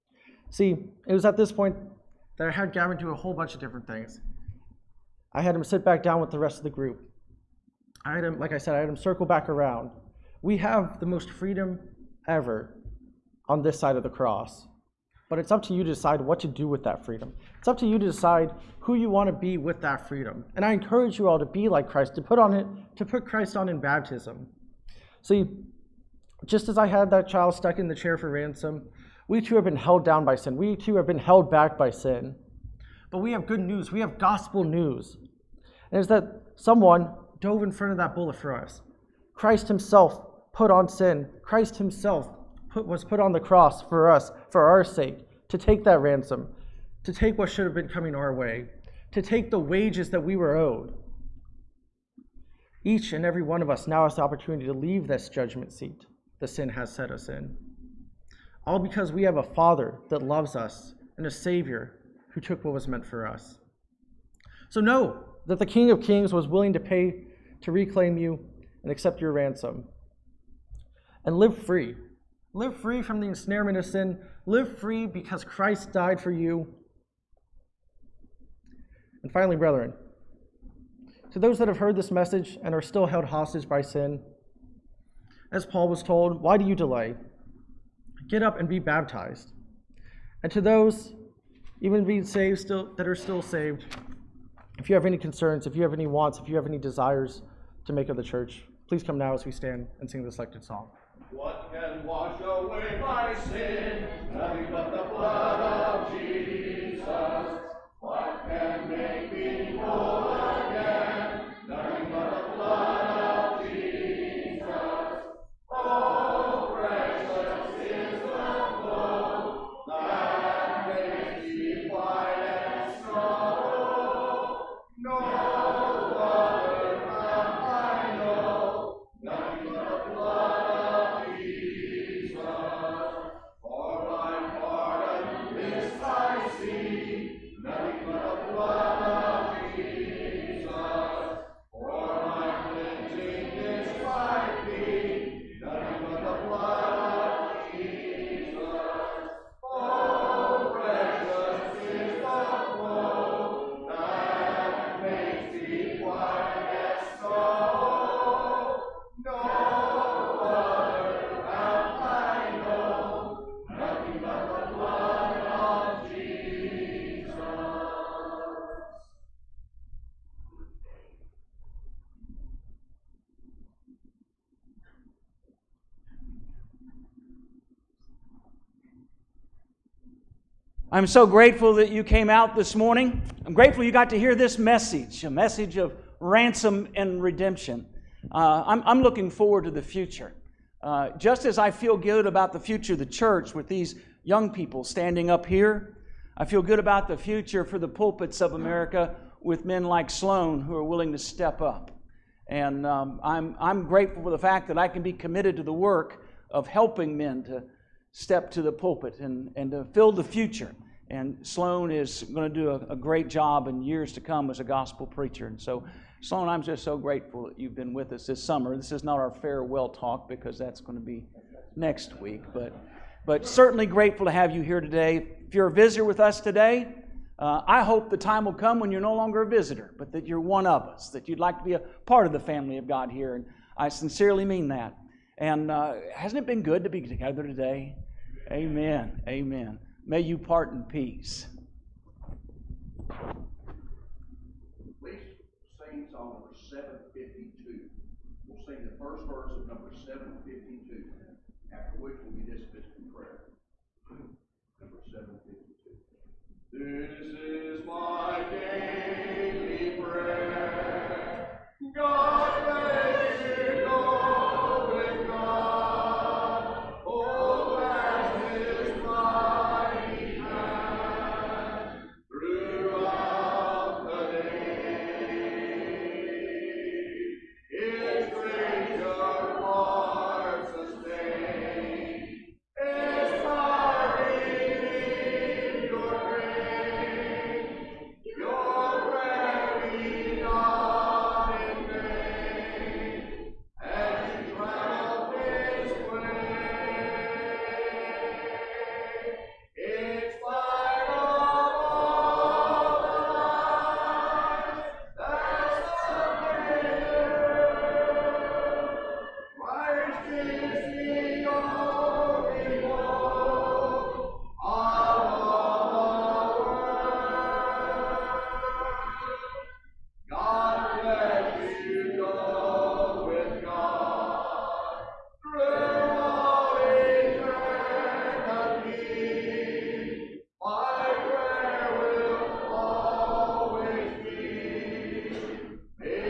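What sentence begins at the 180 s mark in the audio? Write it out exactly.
I'm so grateful that you came out this morning.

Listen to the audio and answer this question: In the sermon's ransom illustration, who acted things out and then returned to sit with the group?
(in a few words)
Gavin.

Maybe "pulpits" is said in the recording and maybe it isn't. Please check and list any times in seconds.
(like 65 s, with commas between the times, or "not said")
197 s, 208 s.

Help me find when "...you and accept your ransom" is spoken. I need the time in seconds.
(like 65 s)
68 s.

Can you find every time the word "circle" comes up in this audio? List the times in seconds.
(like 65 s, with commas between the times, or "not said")
8 s.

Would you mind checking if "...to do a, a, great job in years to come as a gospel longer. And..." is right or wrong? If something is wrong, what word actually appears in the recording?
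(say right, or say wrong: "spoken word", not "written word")
wrong: "preacher", not "longer".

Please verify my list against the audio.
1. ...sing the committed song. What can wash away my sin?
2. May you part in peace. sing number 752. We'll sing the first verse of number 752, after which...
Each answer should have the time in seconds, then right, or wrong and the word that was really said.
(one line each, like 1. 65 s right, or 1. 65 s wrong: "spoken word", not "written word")
1. 100 s wrong: "selected", not "committed"
2. 240 s right.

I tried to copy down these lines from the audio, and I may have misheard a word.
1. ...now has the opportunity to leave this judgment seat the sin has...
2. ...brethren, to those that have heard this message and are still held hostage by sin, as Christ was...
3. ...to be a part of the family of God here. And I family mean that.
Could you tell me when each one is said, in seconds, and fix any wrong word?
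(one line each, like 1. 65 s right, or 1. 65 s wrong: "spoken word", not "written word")
1. 53 s right
2. 79 s wrong: "Paul", not "Christ"
3. 231 s wrong: "sincerely", not "family".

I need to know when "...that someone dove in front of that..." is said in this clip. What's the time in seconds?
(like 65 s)
36 s.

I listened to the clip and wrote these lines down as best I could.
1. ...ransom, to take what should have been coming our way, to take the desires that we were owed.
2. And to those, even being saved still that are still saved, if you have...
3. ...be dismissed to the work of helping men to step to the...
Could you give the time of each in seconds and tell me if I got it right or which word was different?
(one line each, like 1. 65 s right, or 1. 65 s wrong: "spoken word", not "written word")
1. 46 s wrong: "wages", not "desires"
2. 90 s right
3. 205 s wrong: "committed", not "dismissed".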